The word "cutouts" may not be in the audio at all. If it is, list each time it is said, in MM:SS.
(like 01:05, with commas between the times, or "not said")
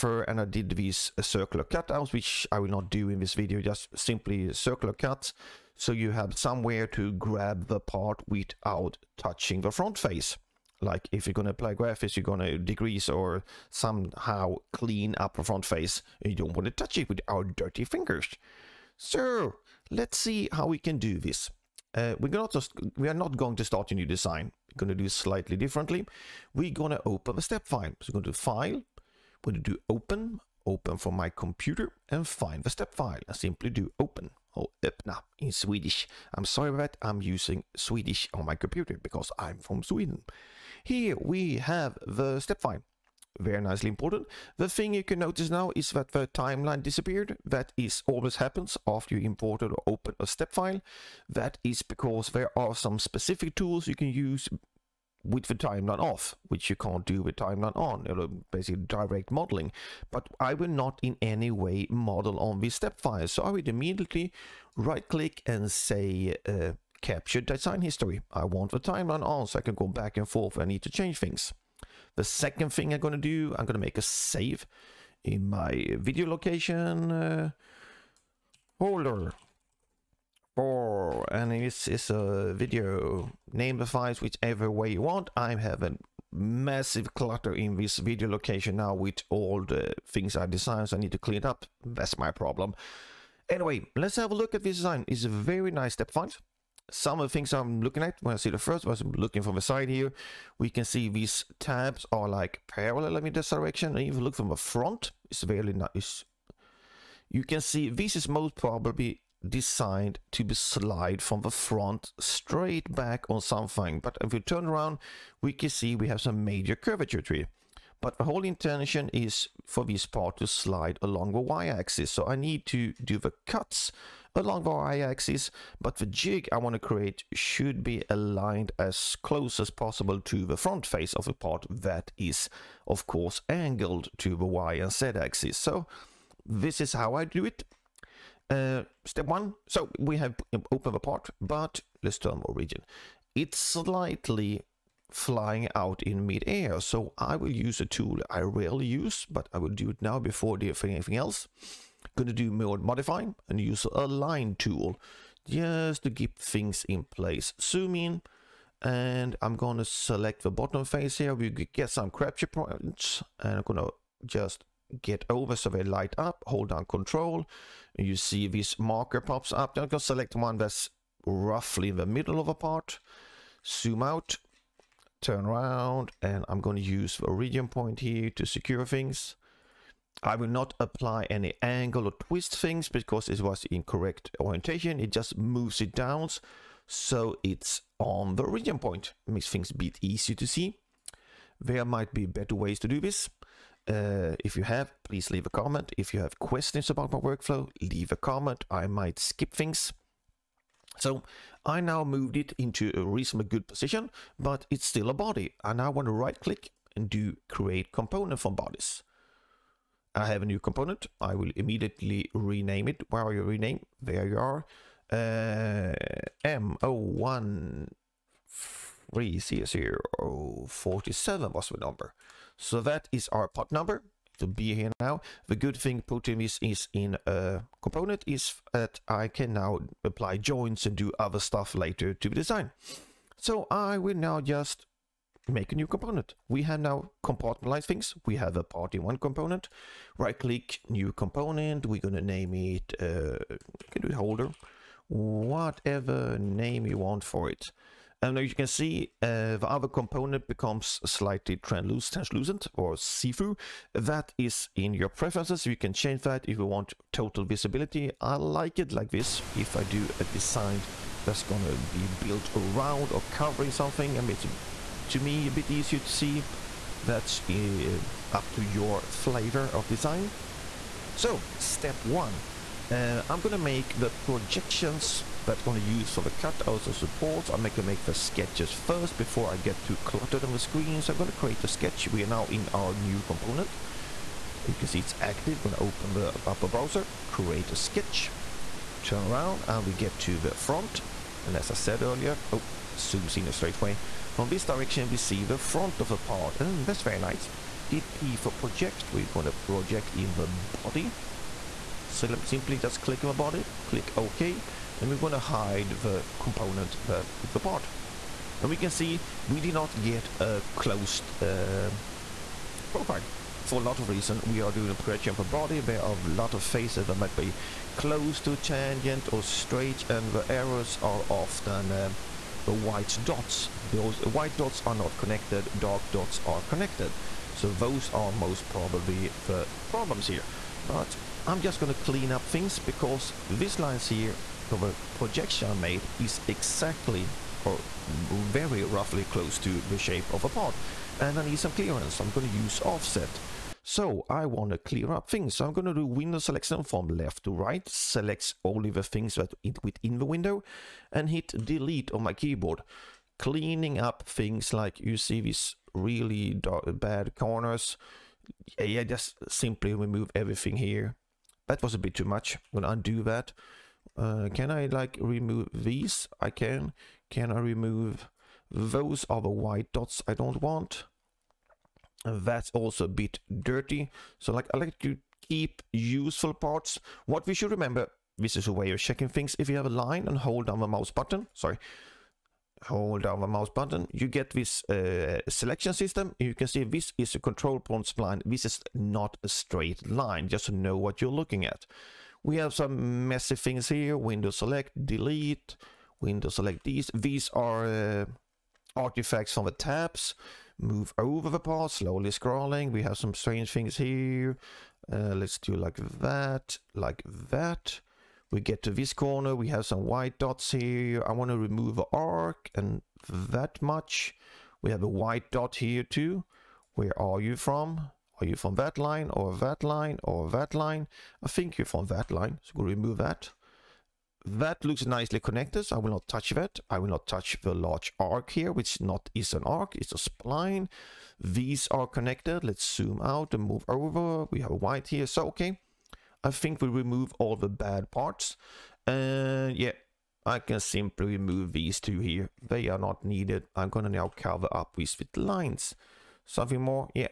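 00:01, 04:36.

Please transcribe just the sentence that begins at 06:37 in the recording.
These are uh, artifacts from the tabs.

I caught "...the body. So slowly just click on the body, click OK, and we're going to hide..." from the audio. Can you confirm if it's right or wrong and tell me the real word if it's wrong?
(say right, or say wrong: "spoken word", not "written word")
wrong: "simply", not "slowly".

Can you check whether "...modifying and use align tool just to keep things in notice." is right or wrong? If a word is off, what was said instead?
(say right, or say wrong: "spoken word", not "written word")
wrong: "place", not "notice".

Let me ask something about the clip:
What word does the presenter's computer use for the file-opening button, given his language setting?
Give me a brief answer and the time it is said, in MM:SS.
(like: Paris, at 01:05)
öppna, at 00:34.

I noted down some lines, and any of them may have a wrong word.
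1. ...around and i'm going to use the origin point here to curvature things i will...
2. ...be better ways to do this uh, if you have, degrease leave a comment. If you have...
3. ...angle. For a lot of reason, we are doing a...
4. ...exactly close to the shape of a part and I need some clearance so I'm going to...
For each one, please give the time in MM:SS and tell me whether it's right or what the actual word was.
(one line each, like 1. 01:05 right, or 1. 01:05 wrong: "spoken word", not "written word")
1. 02:55 wrong: "secure", not "curvature"
2. 03:12 wrong: "please", not "degrease"
3. 05:12 wrong: "profile", not "angle"
4. 05:38 wrong: "roughly", not "exactly".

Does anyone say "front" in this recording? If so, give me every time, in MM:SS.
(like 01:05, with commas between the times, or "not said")
00:09, 00:15, 01:44, 01:51, 02:10, 04:50, 04:55.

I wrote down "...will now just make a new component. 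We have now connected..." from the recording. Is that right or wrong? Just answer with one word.
wrong.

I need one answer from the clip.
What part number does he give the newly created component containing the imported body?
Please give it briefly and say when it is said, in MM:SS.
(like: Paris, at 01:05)
M0130047, at 03:36.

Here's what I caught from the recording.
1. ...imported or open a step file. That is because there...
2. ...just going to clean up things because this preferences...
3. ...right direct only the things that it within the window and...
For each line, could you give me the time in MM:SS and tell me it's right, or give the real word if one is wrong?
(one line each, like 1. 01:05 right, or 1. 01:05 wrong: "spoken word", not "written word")
1. 00:49 right
2. 05:31 wrong: "lines", not "preferences"
3. 05:47 wrong: "select", not "direct".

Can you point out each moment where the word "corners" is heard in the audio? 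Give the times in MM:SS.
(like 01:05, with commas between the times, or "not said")
05:57, 06:49.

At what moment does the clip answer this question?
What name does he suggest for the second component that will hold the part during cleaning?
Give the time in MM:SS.
04:03.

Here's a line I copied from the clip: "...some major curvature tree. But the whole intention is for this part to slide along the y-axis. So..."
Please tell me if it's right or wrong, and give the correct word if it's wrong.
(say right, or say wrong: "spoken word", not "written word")
right.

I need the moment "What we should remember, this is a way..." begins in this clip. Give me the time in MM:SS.
06:17.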